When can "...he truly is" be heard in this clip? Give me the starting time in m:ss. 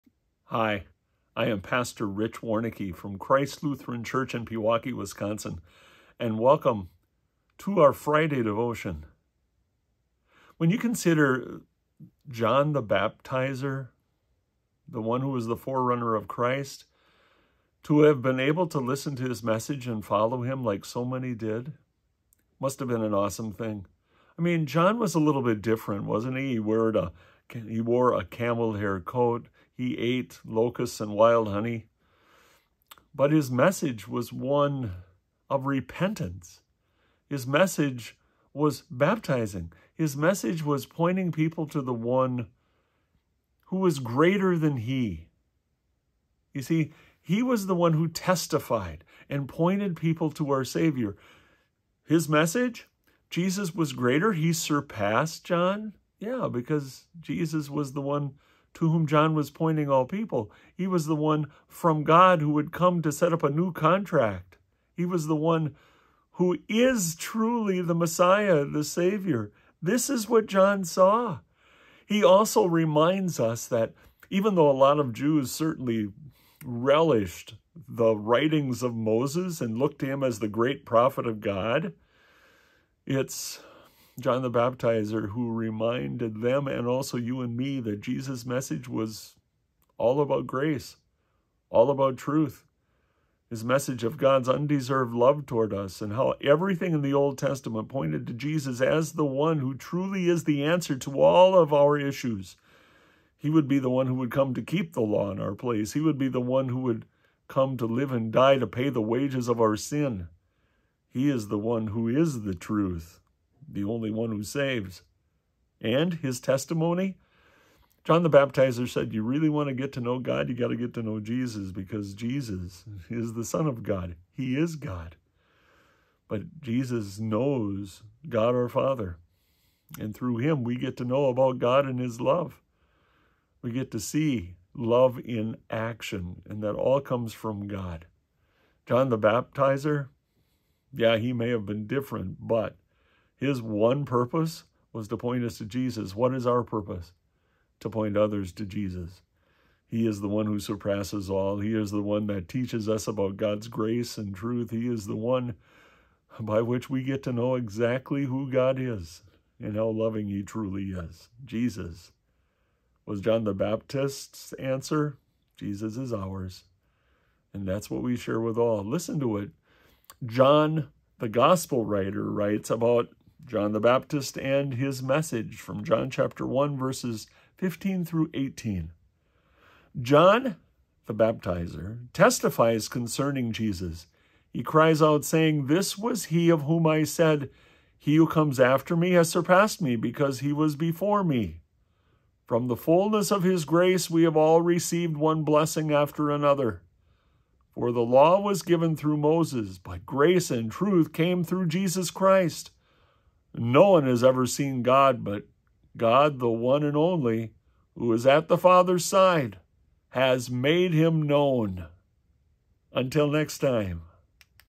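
2:40.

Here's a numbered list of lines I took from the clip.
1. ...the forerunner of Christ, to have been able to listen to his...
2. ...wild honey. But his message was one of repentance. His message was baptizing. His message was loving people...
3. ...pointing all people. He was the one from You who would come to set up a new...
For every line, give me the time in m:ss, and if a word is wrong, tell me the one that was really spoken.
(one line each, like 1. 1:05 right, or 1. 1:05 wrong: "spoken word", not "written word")
1. 0:15 right
2. 0:31 wrong: "pointing", not "loving"
3. 0:59 wrong: "God", not "You".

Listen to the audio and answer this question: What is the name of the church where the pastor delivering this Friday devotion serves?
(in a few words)
Christ Lutheran Church.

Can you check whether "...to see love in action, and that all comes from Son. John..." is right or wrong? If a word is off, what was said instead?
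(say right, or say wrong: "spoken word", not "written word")
wrong: "God", not "Son".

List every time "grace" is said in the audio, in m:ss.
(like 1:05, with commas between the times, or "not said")
1:30, 2:33, 3:13, 3:20.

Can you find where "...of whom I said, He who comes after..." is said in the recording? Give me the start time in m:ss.
3:06.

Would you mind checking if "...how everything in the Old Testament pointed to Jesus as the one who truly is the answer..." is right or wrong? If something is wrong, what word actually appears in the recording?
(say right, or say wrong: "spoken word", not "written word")
right.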